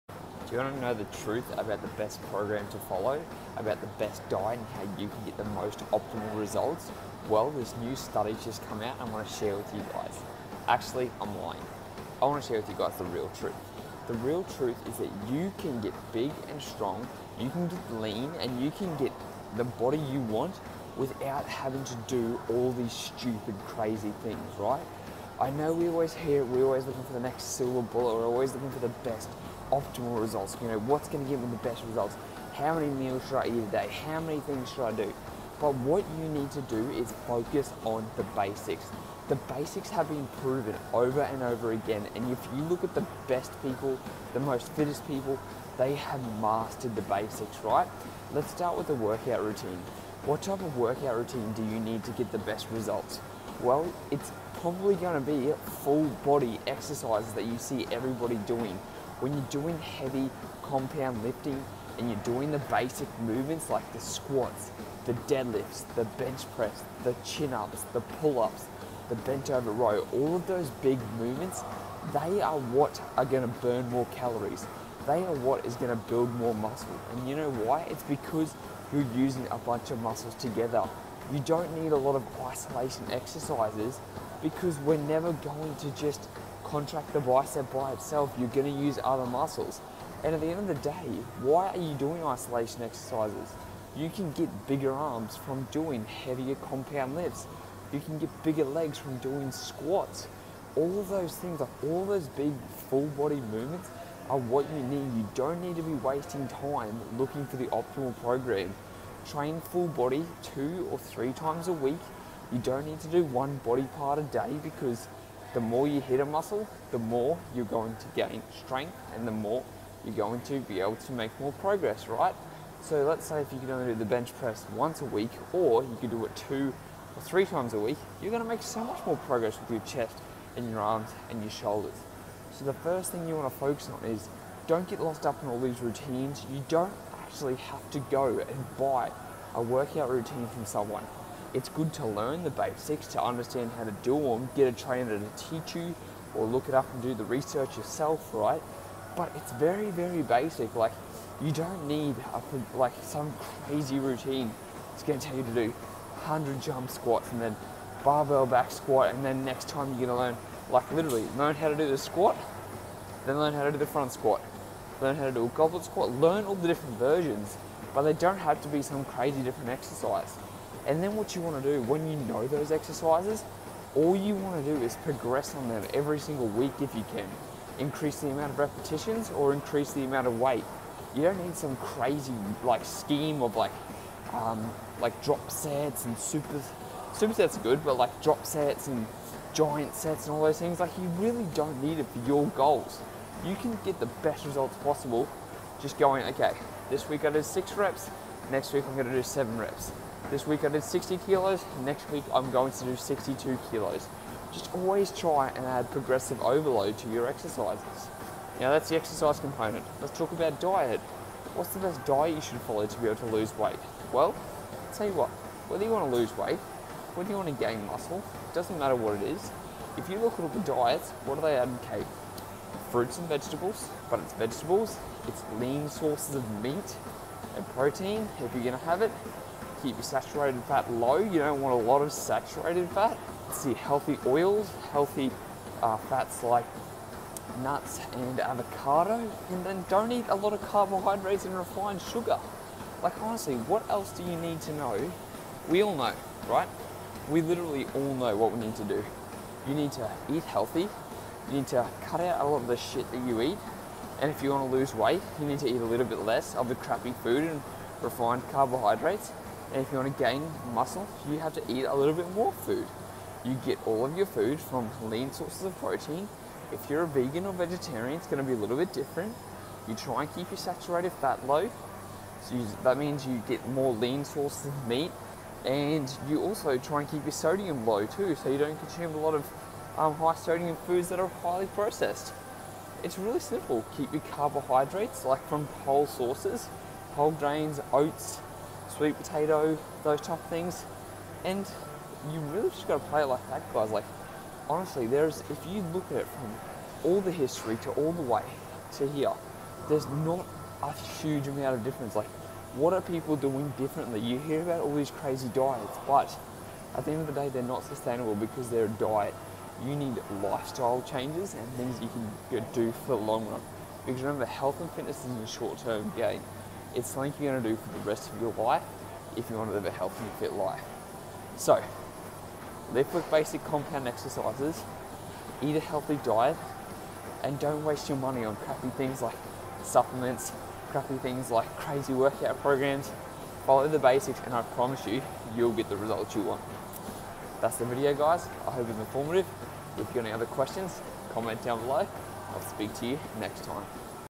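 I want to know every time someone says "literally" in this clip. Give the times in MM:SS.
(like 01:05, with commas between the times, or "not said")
02:40, 04:07.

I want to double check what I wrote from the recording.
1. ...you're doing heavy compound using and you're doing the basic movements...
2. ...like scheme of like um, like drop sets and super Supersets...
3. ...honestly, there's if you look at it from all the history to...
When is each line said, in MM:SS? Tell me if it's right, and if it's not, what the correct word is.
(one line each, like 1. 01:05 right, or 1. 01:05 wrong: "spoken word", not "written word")
1. 00:59 wrong: "lifting", not "using"
2. 03:02 right
3. 04:54 right.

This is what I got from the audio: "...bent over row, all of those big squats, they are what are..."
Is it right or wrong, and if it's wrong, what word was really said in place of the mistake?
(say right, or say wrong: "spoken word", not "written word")
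wrong: "movements", not "squats".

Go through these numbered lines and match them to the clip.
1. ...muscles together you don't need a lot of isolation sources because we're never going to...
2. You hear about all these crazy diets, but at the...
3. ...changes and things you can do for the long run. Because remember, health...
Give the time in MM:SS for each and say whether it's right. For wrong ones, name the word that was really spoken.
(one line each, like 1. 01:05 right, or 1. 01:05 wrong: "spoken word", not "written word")
1. 01:20 wrong: "exercises", not "sources"
2. 05:04 right
3. 05:11 right.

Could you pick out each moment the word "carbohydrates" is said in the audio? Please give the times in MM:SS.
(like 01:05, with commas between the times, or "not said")
04:00, 04:18, 04:44.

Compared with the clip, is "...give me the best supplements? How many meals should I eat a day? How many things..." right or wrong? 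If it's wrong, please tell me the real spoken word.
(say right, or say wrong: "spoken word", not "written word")
wrong: "results", not "supplements".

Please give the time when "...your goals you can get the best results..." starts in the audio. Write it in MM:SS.
03:12.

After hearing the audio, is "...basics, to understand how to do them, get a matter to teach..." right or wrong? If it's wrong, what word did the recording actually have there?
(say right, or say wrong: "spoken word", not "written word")
wrong: "trainer", not "matter".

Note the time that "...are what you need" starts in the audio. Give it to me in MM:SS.
01:44.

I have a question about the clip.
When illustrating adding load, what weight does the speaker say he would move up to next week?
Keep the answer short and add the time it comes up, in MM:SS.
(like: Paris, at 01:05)
62 kilos, at 03:22.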